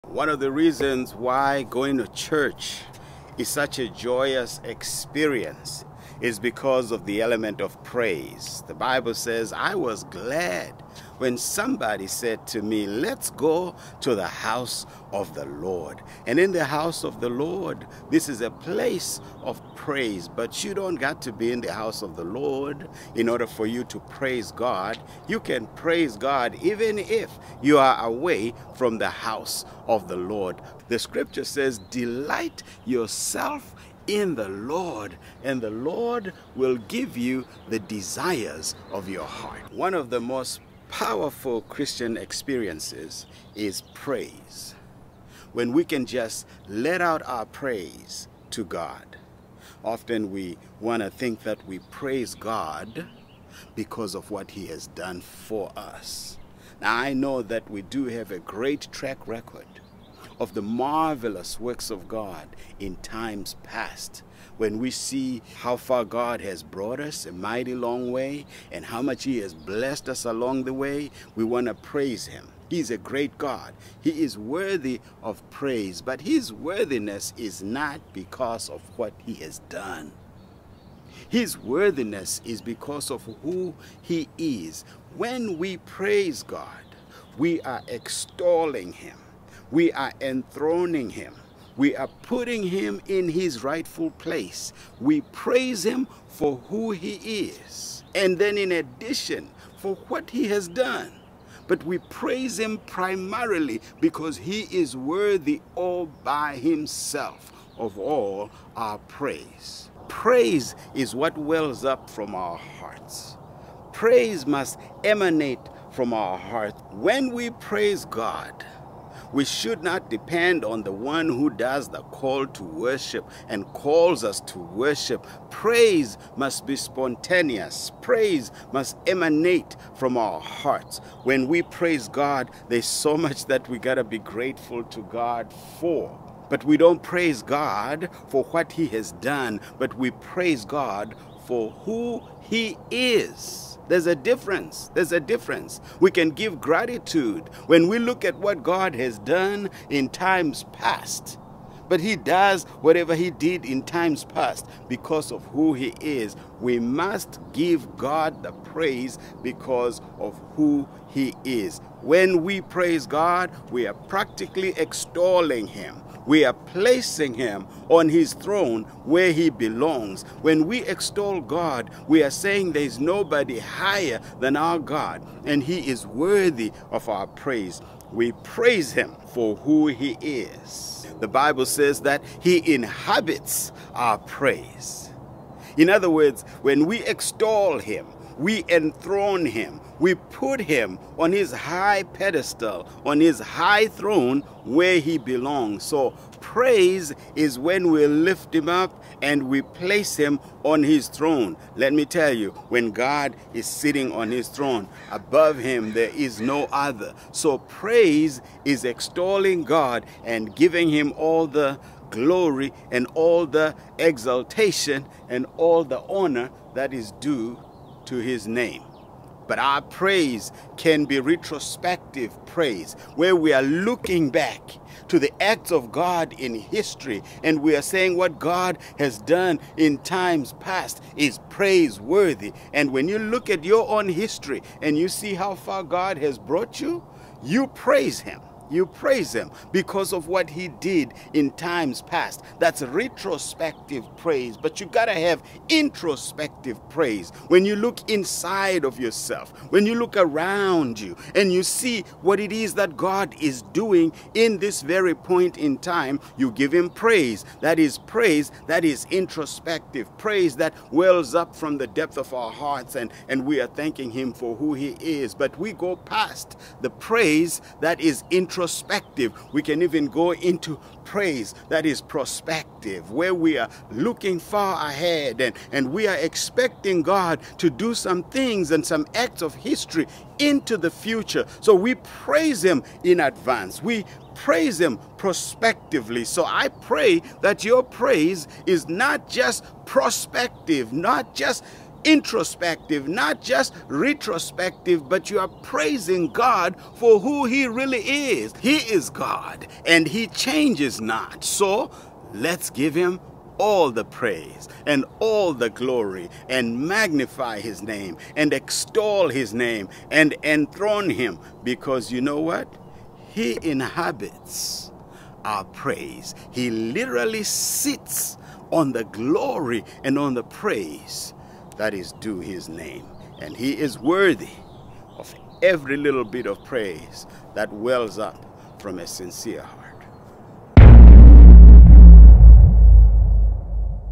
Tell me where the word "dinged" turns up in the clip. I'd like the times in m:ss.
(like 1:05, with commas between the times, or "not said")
not said.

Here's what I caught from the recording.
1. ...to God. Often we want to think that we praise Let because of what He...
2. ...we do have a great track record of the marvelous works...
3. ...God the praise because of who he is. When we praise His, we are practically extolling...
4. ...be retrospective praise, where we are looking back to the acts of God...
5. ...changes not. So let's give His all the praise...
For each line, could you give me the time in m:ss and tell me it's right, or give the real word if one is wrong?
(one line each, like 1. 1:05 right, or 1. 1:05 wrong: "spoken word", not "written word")
1. 0:48 wrong: "God", not "Let"
2. 0:57 right
3. 2:37 wrong: "God", not "His"
4. 3:41 right
5. 5:00 wrong: "Him", not "His".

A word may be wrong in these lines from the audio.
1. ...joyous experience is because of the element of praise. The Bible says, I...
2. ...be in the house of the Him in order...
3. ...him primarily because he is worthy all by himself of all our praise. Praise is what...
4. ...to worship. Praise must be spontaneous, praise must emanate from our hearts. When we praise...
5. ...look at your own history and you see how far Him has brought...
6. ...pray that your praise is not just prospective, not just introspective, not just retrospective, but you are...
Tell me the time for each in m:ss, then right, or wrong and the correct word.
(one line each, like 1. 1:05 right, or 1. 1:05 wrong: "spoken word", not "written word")
1. 0:03 right
2. 0:21 wrong: "Lord", not "Him"
3. 1:42 right
4. 2:04 right
5. 3:53 wrong: "God", not "Him"
6. 4:46 right.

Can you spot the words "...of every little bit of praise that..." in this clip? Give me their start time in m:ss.
5:25.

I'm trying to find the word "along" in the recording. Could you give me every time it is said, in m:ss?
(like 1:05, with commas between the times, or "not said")
1:10.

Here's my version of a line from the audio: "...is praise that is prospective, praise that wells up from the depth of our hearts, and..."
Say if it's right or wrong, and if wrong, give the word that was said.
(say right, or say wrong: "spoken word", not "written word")
wrong: "introspective", not "prospective".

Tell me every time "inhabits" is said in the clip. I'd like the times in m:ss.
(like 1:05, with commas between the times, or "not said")
3:02, 5:13.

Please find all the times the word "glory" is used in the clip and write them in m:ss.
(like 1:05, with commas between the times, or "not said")
3:32, 5:05, 5:19.